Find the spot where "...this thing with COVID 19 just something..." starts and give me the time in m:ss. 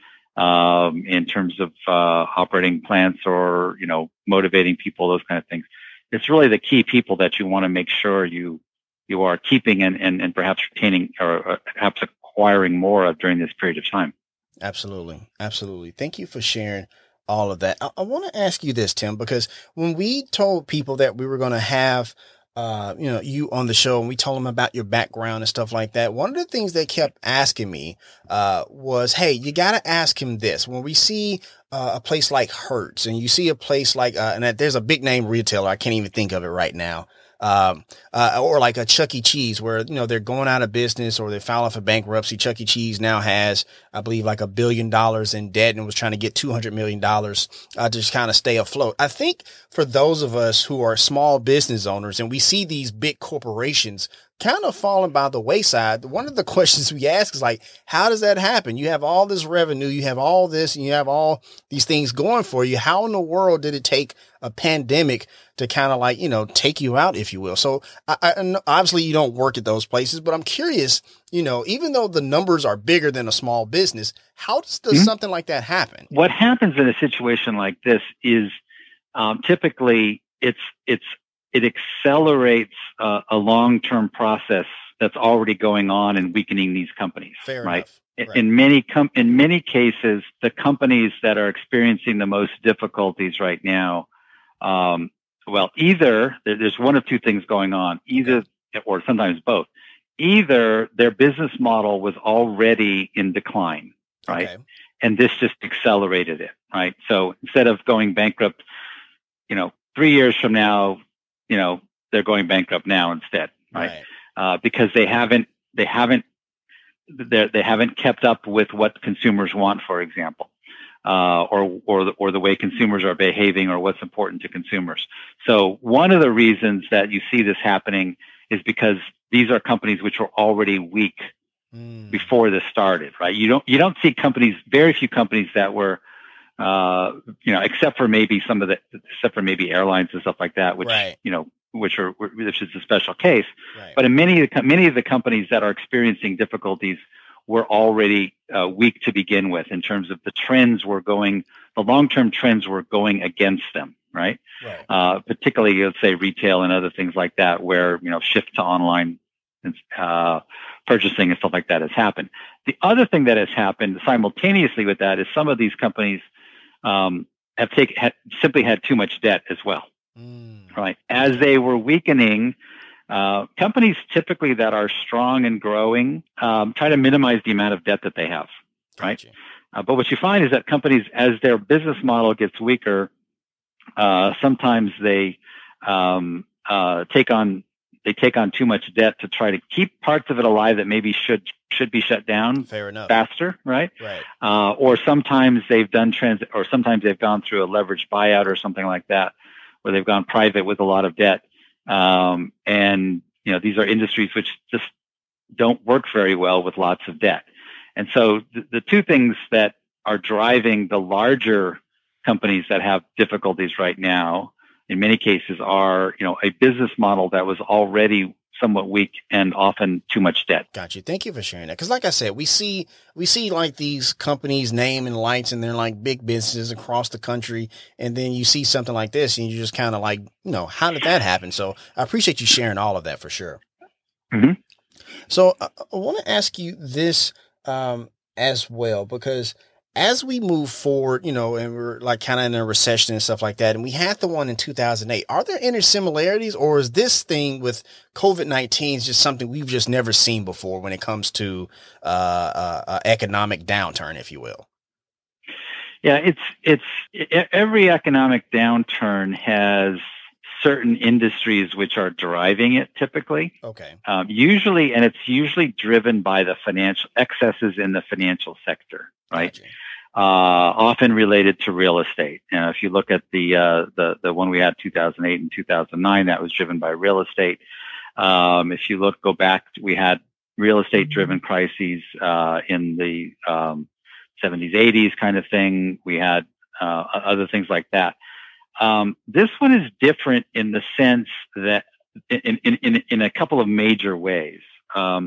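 4:06.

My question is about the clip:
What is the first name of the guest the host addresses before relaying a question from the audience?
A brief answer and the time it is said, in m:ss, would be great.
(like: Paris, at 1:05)
Tim, at 0:18.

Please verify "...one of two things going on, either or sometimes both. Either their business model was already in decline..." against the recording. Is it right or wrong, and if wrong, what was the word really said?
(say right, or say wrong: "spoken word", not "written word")
right.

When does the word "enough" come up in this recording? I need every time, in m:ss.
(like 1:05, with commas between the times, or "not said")
1:28, 3:12.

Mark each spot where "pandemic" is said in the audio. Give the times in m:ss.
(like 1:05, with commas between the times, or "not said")
1:04.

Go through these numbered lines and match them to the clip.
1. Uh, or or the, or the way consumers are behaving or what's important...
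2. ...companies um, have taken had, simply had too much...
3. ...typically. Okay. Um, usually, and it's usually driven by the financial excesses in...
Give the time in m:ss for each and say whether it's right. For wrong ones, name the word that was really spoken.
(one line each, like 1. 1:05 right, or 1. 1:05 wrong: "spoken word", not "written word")
1. 2:01 right
2. 2:45 right
3. 4:22 right.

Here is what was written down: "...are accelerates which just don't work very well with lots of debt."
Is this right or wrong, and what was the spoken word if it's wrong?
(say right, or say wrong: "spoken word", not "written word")
wrong: "industries", not "accelerates".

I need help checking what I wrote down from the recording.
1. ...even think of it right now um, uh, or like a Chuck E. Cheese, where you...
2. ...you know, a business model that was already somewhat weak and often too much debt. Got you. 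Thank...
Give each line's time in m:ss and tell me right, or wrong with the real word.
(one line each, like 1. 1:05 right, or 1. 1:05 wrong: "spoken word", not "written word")
1. 0:35 right
2. 3:36 right.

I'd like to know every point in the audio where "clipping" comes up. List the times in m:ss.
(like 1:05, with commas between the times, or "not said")
not said.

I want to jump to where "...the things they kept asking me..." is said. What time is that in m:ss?
0:26.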